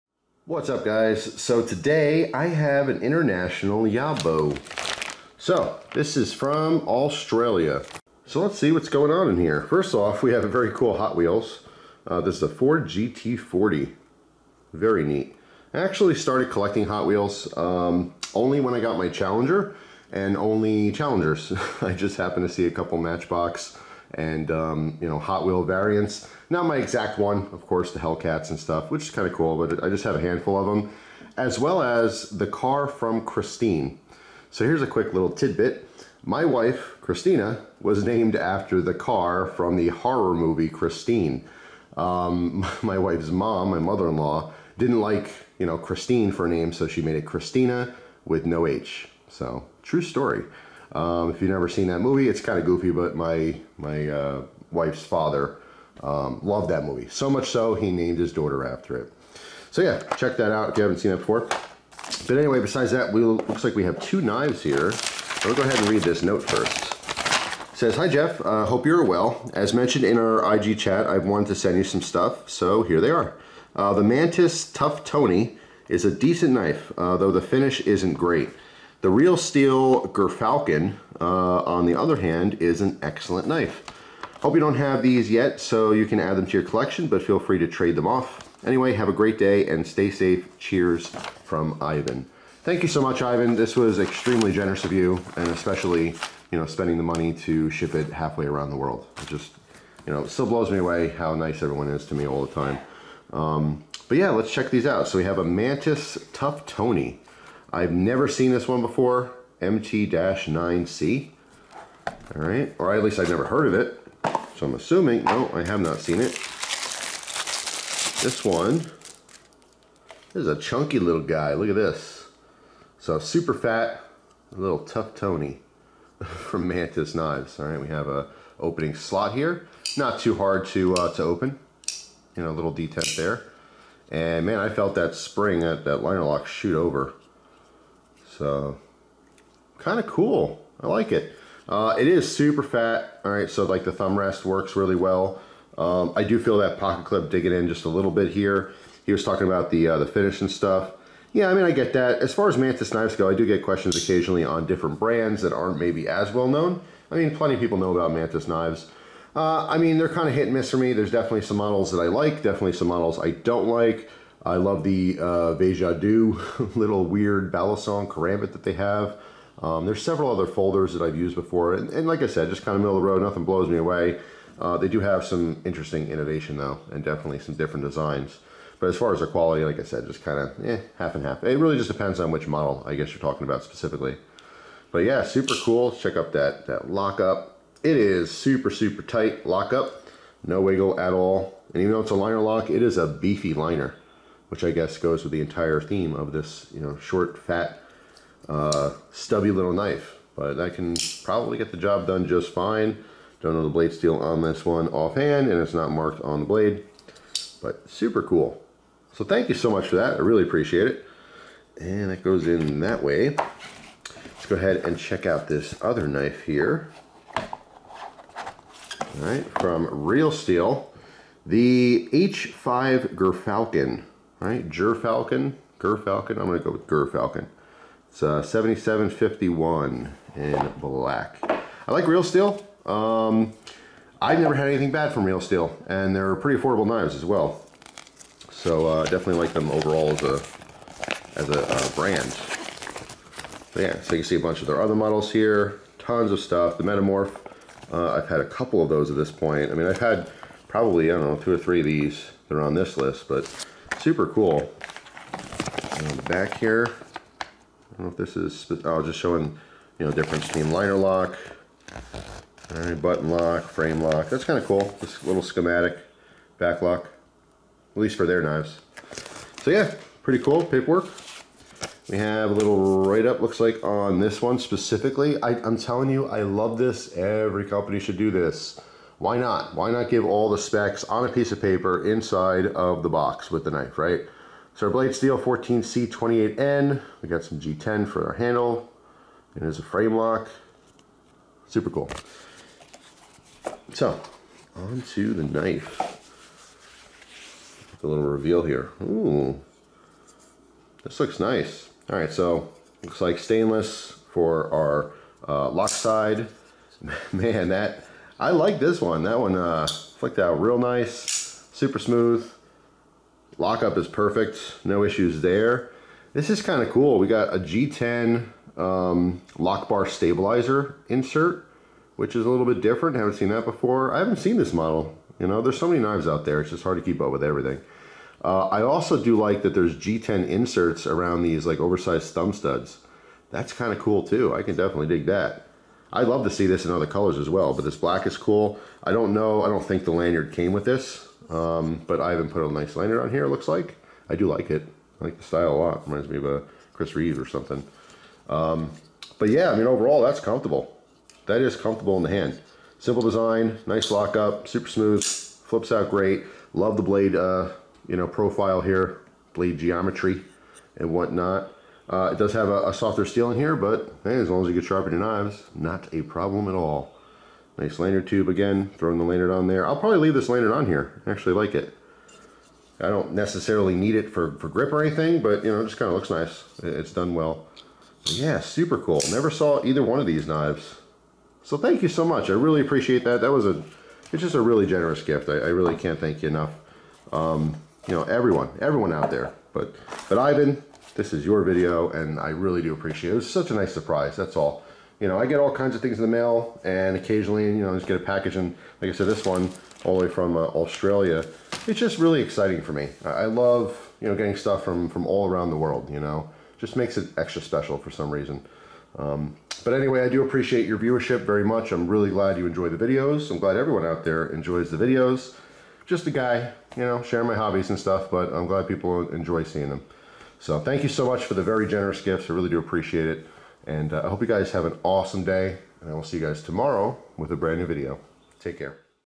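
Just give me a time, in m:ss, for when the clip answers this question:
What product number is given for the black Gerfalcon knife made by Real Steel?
3:48.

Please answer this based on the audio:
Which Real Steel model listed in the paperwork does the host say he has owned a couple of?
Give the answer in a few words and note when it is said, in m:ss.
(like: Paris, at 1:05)
Metamorph, at 4:06.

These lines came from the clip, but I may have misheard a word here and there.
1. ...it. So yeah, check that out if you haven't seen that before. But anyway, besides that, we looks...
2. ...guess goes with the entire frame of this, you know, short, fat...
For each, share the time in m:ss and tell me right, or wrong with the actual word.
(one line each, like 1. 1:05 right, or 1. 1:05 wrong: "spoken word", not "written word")
1. 0:58 right
2. 3:14 wrong: "theme", not "frame".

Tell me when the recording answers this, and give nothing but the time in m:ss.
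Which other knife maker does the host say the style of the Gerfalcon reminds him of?
5:46.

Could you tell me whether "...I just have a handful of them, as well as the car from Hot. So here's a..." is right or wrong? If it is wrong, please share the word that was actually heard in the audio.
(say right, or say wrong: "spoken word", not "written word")
wrong: "Christine", not "Hot".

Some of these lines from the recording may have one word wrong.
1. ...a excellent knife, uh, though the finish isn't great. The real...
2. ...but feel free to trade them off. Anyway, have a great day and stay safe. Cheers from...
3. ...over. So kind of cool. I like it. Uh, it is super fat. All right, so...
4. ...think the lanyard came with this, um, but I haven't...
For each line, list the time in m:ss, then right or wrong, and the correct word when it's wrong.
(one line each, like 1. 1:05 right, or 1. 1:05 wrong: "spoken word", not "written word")
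1. 1:16 wrong: "decent", not "excellent"
2. 1:27 right
3. 2:16 right
4. 5:39 right.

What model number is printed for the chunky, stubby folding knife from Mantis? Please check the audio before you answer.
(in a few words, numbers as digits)
MT-9C.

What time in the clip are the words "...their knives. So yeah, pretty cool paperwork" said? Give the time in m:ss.
4:28.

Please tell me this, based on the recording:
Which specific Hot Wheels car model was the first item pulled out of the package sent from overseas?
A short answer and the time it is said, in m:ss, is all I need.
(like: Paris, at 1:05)
Ford GT40, at 0:12.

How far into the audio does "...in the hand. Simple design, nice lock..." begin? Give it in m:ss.
5:52.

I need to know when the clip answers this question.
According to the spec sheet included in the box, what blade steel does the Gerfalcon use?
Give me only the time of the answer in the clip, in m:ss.
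4:45.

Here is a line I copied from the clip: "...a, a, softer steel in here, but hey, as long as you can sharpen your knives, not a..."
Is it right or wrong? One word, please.
right.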